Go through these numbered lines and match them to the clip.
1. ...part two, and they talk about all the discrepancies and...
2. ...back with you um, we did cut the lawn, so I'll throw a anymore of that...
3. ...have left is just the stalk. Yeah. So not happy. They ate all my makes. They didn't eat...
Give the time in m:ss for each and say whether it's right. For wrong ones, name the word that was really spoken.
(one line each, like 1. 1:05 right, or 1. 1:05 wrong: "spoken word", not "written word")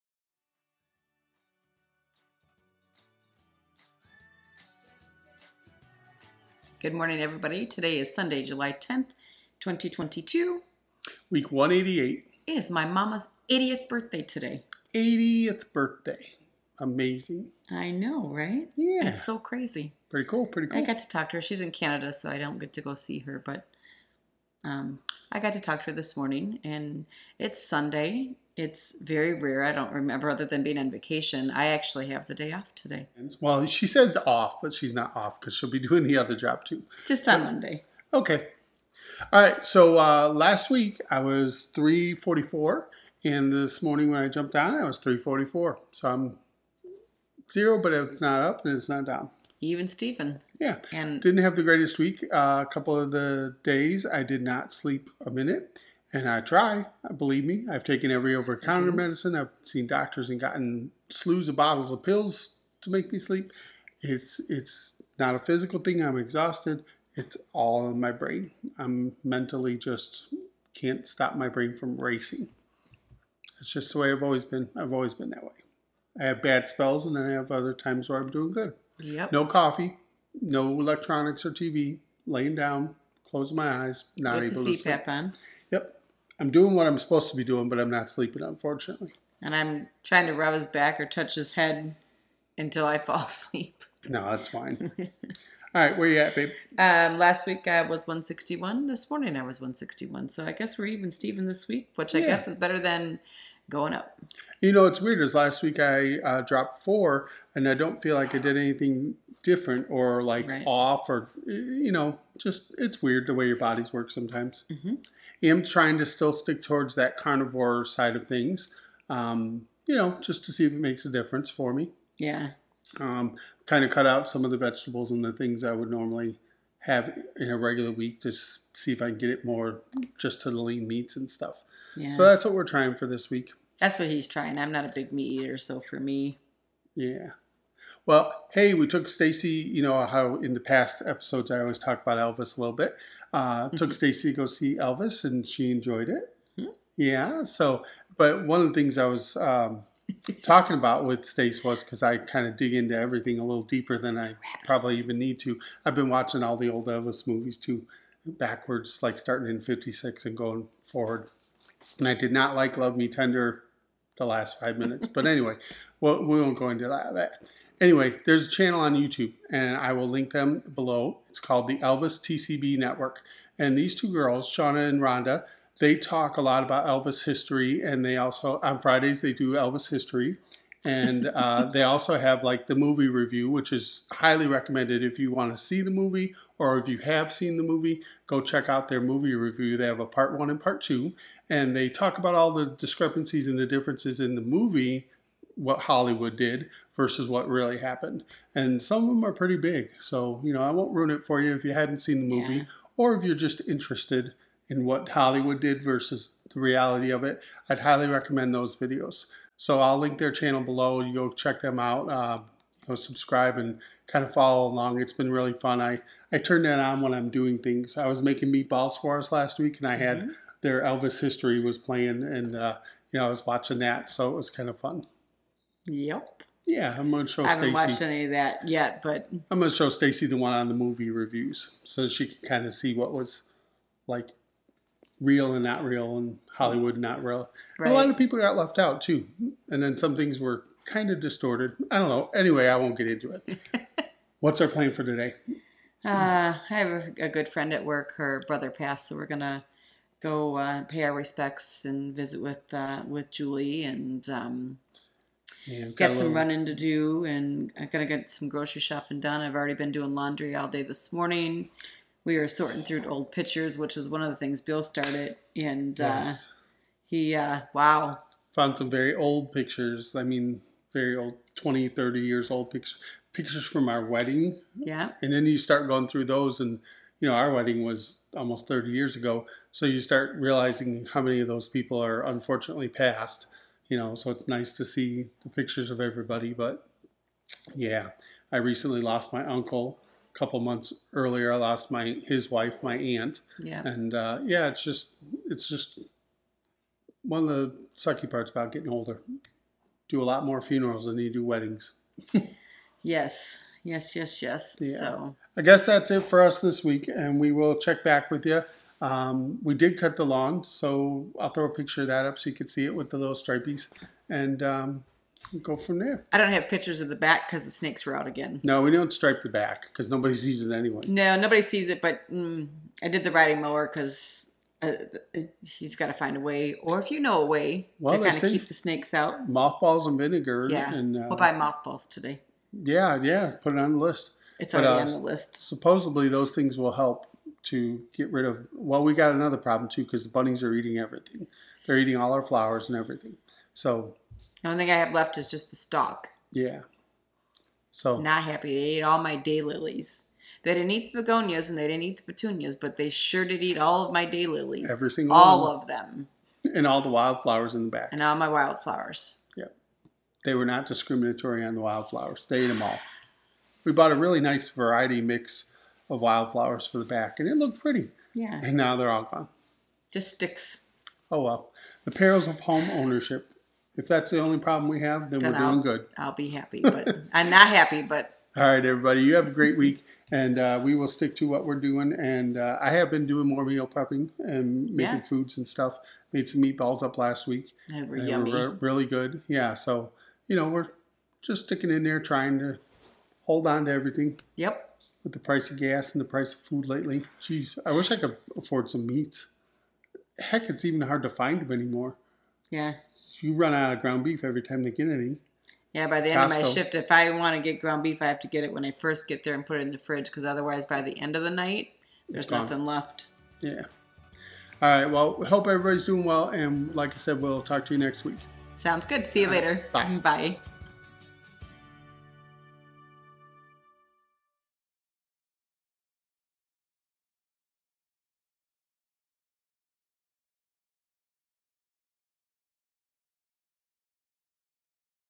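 1. 3:10 right
2. 5:08 wrong: "picture", not "anymore"
3. 5:44 wrong: "daylilies", not "makes".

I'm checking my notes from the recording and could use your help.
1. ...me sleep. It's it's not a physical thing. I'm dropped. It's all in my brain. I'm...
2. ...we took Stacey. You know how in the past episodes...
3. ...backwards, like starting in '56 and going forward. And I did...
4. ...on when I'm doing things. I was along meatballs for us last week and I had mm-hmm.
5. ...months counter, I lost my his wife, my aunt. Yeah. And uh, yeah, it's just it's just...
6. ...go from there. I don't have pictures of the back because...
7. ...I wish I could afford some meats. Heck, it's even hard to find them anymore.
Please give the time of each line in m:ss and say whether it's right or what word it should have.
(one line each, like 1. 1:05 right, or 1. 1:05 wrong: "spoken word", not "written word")
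1. 1:03 wrong: "exhausted", not "dropped"
2. 2:18 right
3. 2:38 right
4. 3:36 wrong: "making", not "along"
5. 4:50 wrong: "earlier", not "counter"
6. 5:15 right
7. 6:37 right.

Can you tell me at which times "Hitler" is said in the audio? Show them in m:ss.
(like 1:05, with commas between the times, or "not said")
not said.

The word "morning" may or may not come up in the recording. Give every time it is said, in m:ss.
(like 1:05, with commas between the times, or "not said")
0:06, 0:26, 0:43, 1:39, 4:21.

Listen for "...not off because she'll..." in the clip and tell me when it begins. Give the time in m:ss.
0:34.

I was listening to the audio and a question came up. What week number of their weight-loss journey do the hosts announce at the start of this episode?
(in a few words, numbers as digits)
188.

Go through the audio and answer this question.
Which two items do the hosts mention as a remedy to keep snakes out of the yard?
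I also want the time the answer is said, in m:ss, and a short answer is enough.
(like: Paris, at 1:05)
Mothballs and vinegar, at 5:29.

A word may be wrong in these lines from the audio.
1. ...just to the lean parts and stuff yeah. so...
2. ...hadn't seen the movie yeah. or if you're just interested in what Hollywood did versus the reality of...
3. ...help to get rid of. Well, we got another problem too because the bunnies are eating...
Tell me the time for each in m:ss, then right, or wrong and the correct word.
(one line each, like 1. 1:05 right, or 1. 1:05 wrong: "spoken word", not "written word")
1. 2:10 wrong: "meats", not "parts"
2. 3:21 right
3. 5:36 right.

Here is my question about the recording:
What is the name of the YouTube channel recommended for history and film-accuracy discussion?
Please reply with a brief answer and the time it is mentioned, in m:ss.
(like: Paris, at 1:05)
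Elvis TCB Network, at 2:51.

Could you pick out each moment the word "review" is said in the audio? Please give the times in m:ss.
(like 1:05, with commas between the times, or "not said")
3:03, 3:09, 3:51.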